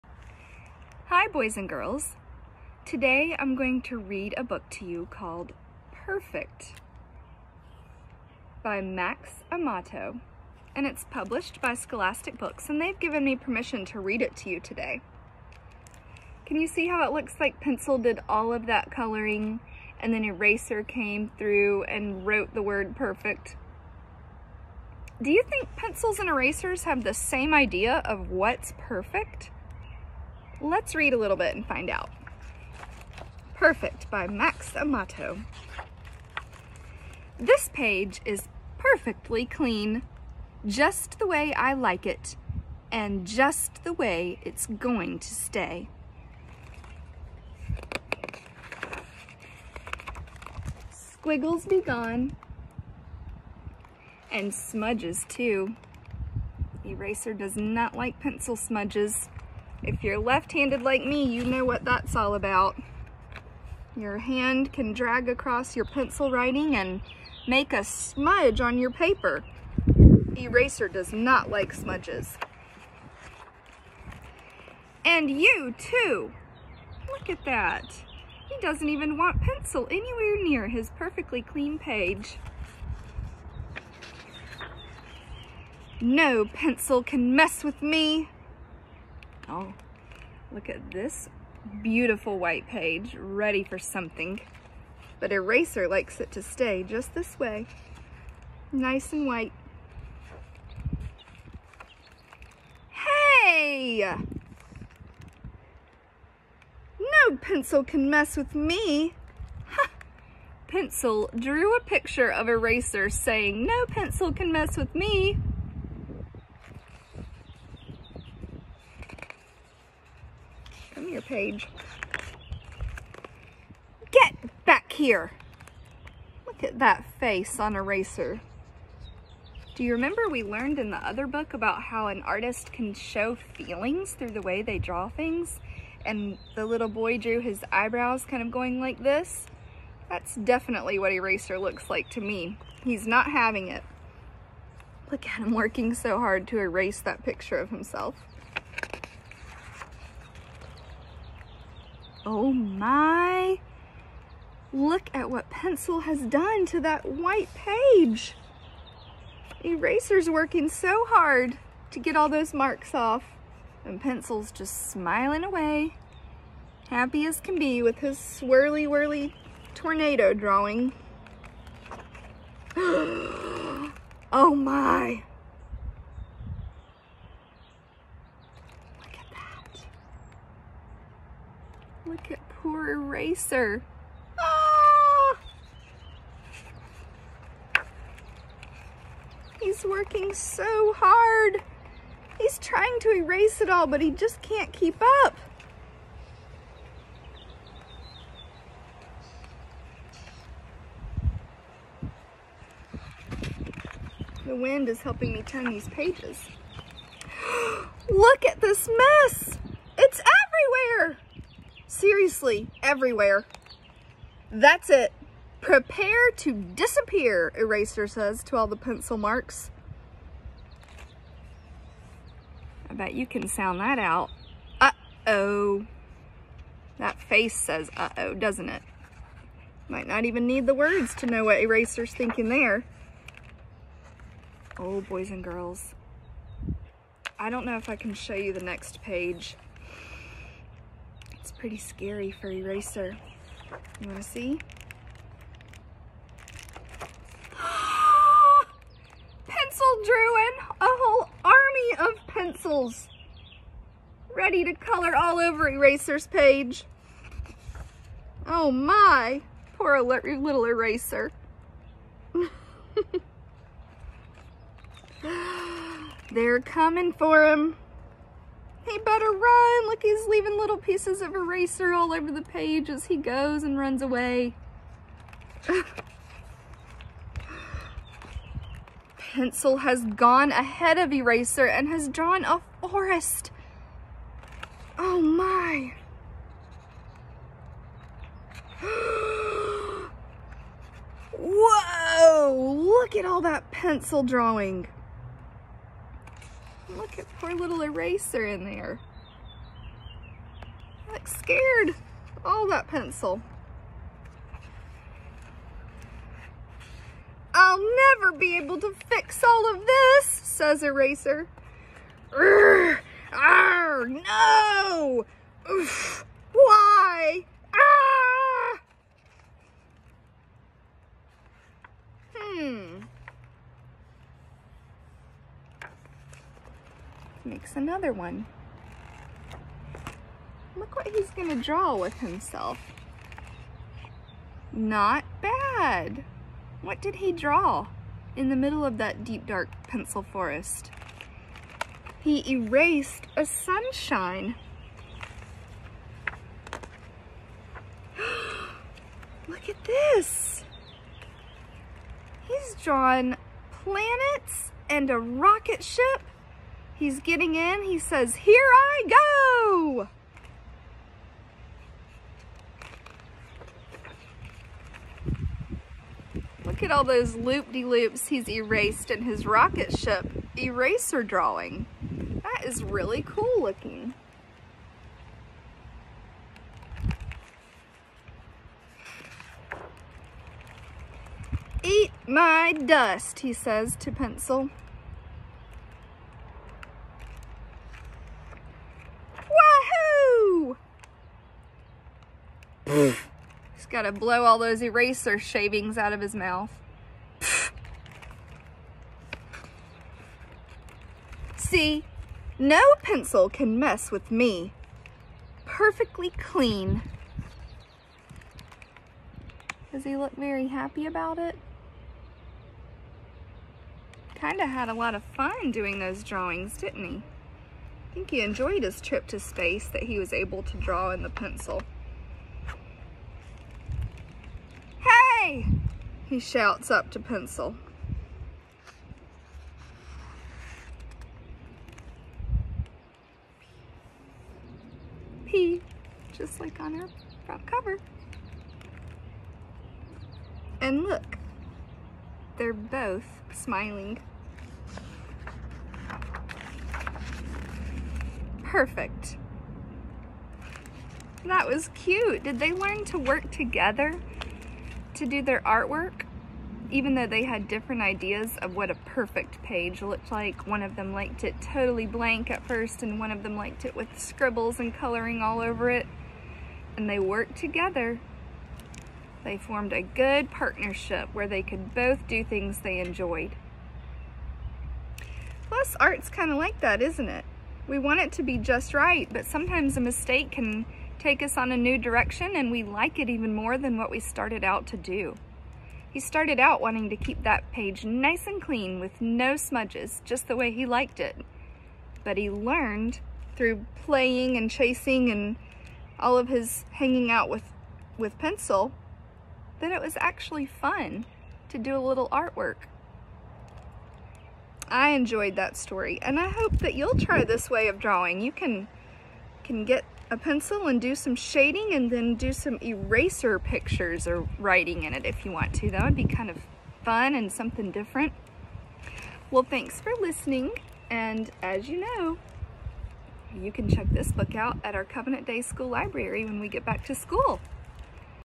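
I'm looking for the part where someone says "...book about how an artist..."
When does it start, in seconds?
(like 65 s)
131 s.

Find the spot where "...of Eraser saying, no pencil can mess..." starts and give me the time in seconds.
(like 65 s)
112 s.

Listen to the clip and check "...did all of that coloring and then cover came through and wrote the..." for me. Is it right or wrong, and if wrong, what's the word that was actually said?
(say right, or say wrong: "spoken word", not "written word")
wrong: "eraser", not "cover".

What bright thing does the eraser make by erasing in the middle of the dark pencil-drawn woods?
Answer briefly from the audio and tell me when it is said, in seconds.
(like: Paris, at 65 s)
a sunshine, at 343 s.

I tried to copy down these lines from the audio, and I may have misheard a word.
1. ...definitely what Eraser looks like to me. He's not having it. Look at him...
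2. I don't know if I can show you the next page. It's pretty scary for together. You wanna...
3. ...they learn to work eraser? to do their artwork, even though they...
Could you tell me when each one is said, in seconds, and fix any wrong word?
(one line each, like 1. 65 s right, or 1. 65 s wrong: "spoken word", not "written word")
1. 140 s right
2. 237 s wrong: "eraser", not "together"
3. 452 s wrong: "together", not "eraser".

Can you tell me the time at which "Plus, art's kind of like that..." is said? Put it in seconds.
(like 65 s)
475 s.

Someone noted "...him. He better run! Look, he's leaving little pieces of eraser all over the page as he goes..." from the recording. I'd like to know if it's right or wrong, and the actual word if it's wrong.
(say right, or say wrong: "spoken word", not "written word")
right.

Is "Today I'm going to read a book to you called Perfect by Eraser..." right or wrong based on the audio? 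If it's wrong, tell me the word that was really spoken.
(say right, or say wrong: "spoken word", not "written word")
wrong: "Max", not "Eraser".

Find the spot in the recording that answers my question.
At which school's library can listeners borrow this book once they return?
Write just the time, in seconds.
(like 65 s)
525 s.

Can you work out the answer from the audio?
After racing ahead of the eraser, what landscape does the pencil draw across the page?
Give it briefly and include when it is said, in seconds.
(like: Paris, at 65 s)
a forest, at 282 s.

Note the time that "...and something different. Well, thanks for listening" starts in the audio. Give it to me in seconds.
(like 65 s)
517 s.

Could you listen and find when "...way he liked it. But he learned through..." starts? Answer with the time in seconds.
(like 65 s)
490 s.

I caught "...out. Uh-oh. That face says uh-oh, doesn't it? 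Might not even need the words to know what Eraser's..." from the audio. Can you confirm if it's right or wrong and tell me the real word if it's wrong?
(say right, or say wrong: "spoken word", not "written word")
right.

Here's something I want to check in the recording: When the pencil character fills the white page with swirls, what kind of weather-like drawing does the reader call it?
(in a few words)
tornado.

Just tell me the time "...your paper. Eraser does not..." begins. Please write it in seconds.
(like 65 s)
68 s.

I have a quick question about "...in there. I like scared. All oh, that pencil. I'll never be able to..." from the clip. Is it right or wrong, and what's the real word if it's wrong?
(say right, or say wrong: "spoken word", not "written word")
right.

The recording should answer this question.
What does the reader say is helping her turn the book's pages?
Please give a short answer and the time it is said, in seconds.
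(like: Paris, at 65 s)
The wind, at 204 s.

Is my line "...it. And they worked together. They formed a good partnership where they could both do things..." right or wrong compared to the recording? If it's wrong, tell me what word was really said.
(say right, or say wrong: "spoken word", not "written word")
right.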